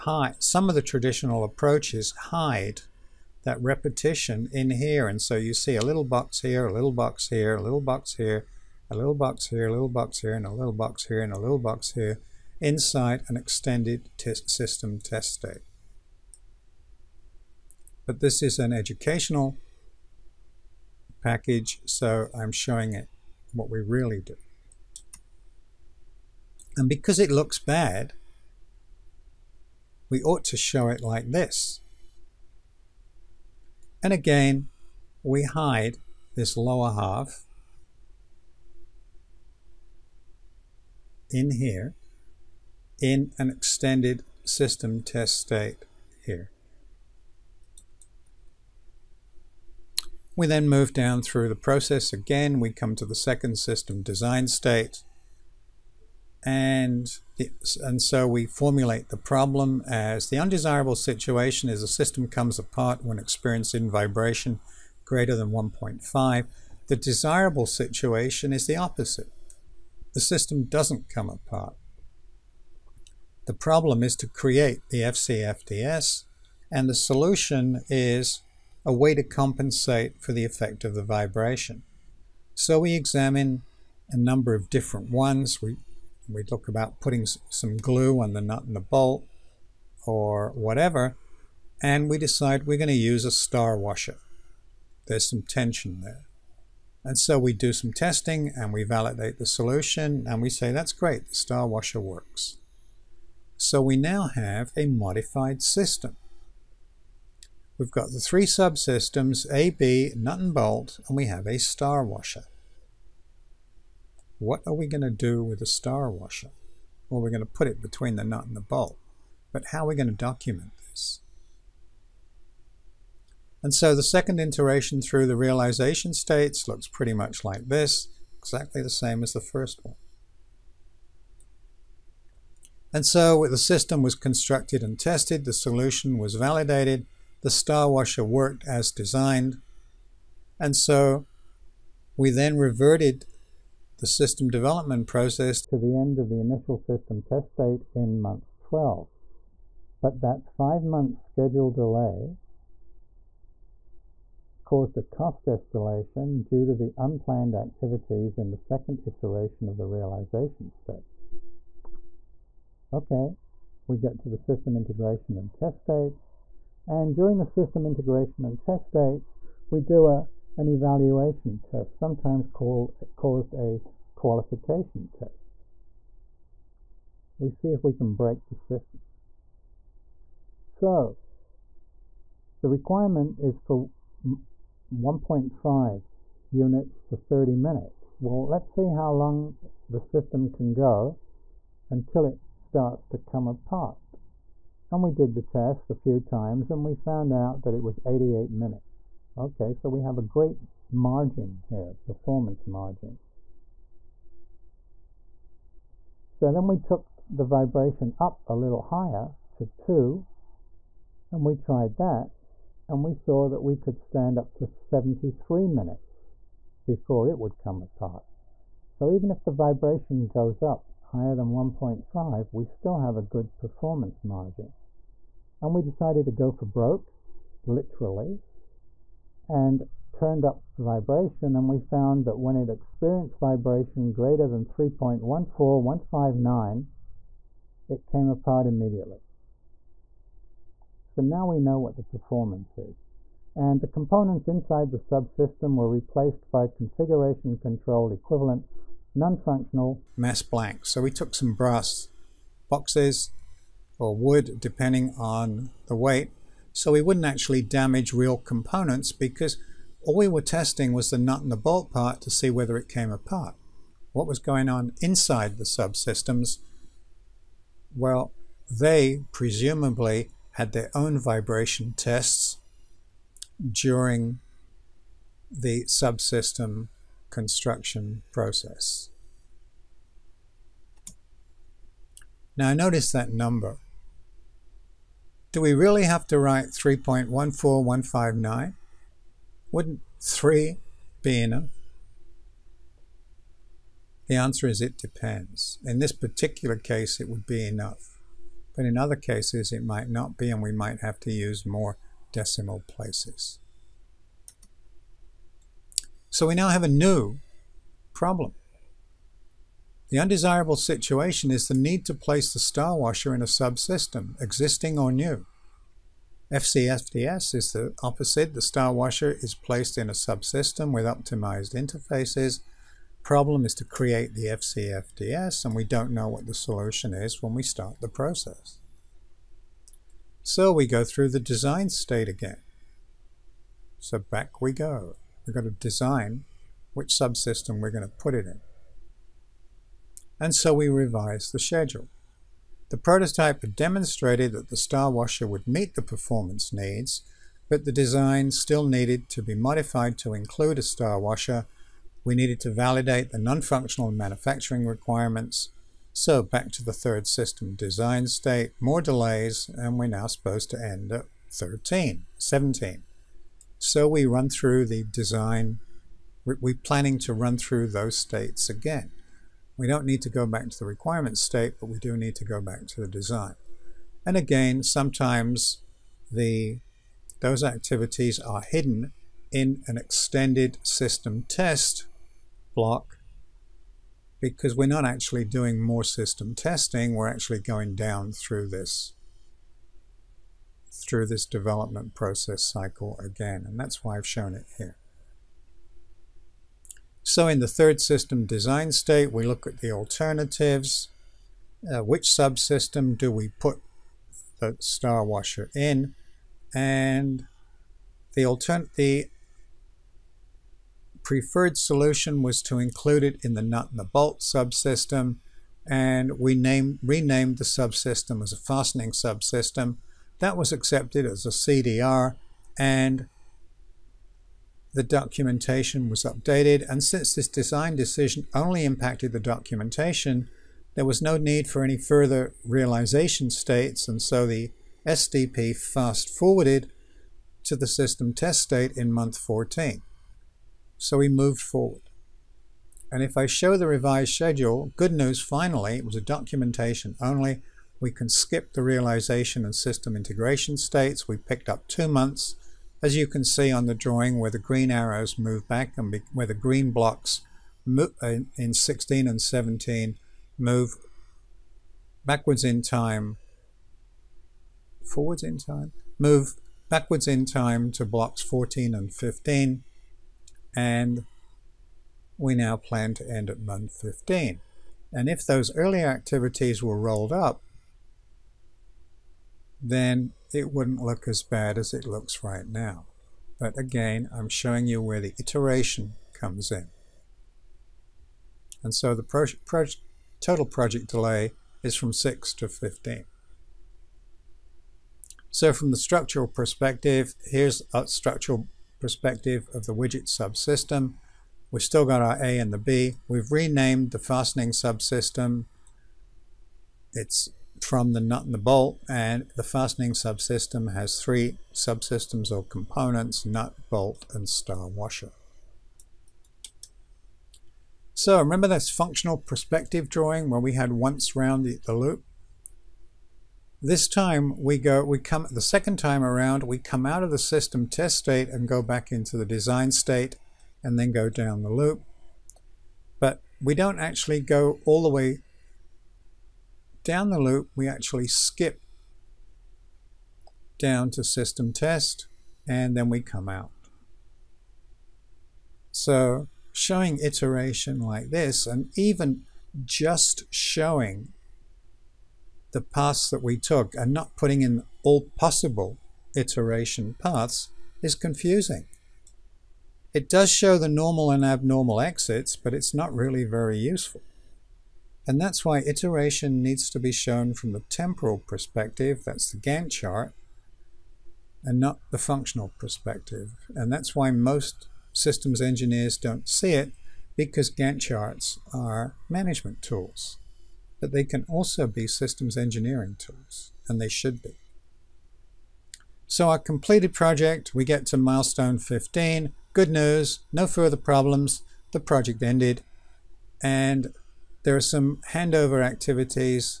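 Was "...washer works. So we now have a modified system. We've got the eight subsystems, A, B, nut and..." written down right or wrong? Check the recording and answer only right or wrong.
wrong.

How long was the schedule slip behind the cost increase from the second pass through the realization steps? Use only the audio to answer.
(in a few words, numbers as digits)
five month.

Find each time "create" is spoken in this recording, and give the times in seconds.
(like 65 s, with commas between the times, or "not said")
74 s, 323 s.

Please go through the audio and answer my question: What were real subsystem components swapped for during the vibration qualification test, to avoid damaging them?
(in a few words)
non-functional mass blanks.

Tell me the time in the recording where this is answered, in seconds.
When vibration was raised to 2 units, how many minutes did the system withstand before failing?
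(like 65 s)
214 s.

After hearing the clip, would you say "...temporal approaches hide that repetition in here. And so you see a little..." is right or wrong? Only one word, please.
wrong.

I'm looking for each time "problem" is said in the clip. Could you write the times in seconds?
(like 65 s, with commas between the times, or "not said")
59 s, 73 s, 308 s, 323 s, 590 s.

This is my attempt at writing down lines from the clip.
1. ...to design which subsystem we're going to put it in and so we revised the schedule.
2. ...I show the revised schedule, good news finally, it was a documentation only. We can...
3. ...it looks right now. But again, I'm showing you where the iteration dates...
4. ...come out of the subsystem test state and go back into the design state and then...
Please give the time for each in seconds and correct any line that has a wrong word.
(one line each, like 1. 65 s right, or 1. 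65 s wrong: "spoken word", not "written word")
1. 335 s right
2. 443 s right
3. 481 s wrong: "comes", not "dates"
4. 526 s wrong: "system", not "subsystem".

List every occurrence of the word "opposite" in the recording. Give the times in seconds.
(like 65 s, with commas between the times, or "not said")
68 s, 318 s.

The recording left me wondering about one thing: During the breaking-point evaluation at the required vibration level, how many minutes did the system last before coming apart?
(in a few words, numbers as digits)
88.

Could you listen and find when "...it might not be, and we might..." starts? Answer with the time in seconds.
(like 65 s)
299 s.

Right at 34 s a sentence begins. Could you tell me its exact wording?
And again, we hide this lower half in here in an extended system test state here.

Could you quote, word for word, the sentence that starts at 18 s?
But this is an educational package, so I'm showing it what we really do.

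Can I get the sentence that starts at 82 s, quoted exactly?
So we examine a number of different ones.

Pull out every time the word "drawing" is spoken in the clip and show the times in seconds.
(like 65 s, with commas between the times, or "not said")
453 s, 520 s.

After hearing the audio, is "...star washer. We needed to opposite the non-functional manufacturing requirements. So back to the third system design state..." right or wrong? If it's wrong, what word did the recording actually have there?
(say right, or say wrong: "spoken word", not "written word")
wrong: "validate", not "opposite".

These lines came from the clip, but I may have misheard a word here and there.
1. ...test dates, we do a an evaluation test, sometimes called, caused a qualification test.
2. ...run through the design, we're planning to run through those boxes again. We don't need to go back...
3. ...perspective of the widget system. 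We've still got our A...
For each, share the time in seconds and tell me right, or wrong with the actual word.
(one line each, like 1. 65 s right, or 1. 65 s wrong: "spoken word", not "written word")
1. 168 s right
2. 364 s wrong: "states", not "boxes"
3. 499 s wrong: "subsystem", not "system".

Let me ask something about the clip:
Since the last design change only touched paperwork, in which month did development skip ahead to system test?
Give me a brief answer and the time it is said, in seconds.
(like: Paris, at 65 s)
14, at 439 s.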